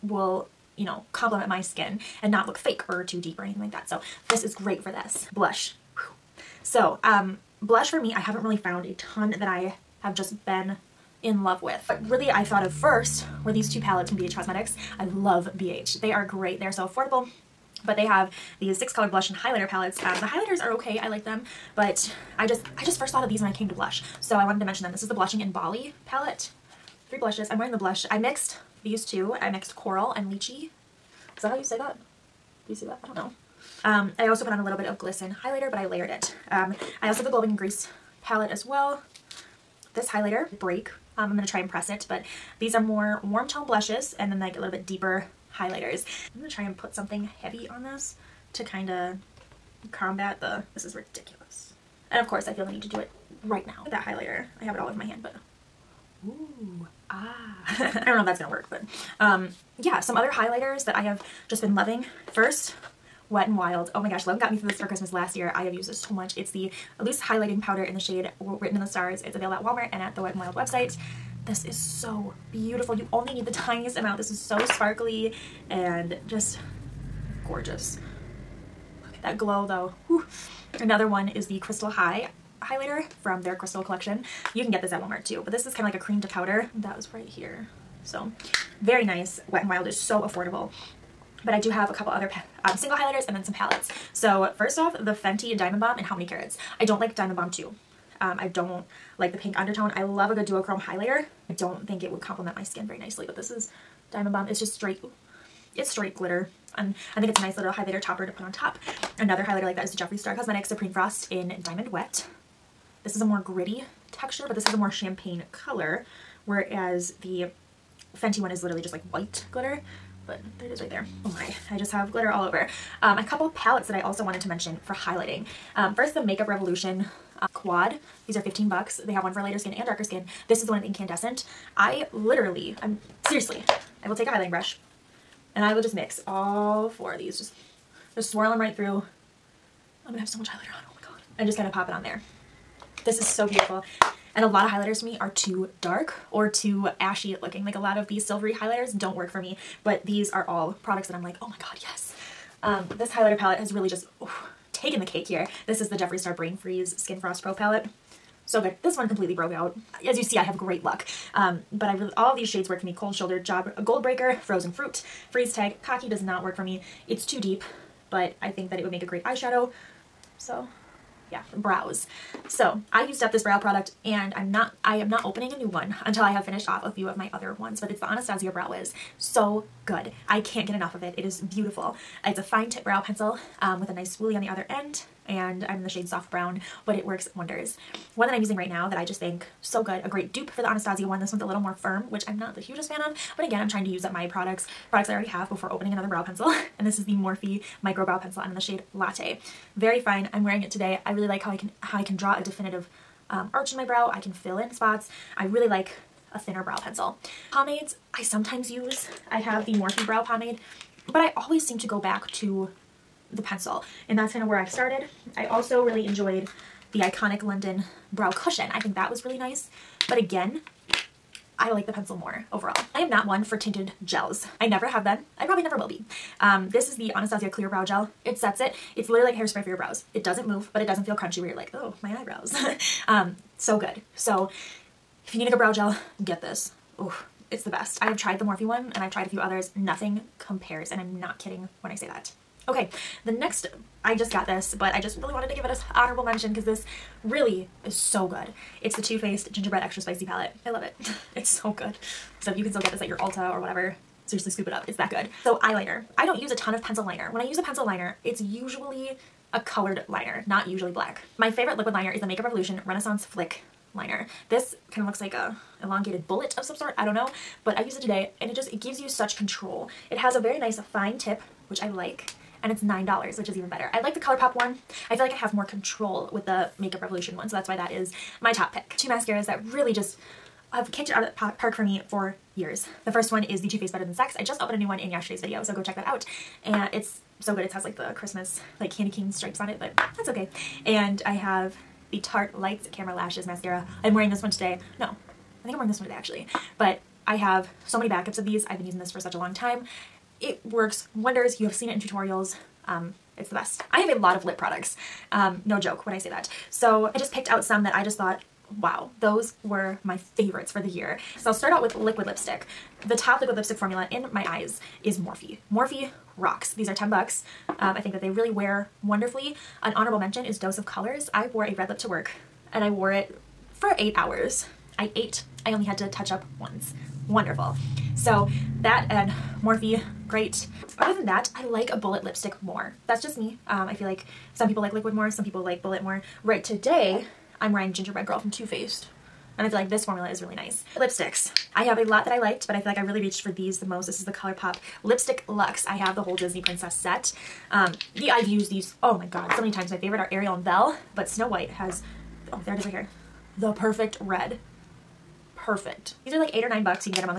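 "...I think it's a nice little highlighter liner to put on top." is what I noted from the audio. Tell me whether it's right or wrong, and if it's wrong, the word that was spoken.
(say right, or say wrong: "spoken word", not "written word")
wrong: "topper", not "liner".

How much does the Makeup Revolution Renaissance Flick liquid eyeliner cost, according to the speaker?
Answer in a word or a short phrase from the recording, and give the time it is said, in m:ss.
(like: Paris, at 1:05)
$9, at 4:32.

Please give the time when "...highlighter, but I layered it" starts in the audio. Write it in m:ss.
0:35.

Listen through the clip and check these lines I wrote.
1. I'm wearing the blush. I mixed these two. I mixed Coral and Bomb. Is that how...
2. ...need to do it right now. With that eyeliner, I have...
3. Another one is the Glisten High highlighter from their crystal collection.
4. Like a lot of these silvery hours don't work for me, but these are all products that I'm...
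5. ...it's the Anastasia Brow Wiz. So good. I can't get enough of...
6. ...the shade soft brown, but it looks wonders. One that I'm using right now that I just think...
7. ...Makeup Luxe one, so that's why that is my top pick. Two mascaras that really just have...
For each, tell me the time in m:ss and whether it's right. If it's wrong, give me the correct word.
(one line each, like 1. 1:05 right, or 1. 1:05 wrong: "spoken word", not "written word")
1. 0:27 wrong: "Lychee", not "Bomb"
2. 0:52 wrong: "highlighter", not "eyeliner"
3. 1:20 wrong: "Crystal", not "Glisten"
4. 2:27 wrong: "highlighters", not "hours"
5. 2:57 right
6. 3:05 wrong: "works", not "looks"
7. 4:36 wrong: "Revolution", not "Luxe".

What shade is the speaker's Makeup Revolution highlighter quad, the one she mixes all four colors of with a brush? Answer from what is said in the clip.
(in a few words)
Incandescent.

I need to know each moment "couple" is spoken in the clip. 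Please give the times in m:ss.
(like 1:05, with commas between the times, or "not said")
1:31, 2:03.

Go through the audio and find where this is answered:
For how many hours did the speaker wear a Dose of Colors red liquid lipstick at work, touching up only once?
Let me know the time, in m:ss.
5:23.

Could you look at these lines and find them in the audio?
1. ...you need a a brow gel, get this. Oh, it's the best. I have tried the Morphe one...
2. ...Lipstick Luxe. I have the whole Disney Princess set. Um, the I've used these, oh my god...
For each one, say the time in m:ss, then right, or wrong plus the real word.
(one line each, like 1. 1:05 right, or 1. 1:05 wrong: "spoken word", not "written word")
1. 3:55 right
2. 5:45 right.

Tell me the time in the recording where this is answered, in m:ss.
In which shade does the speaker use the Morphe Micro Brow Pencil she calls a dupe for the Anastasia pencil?
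3:18.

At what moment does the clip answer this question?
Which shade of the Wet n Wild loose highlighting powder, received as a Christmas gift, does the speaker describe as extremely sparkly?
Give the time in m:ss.
1:08.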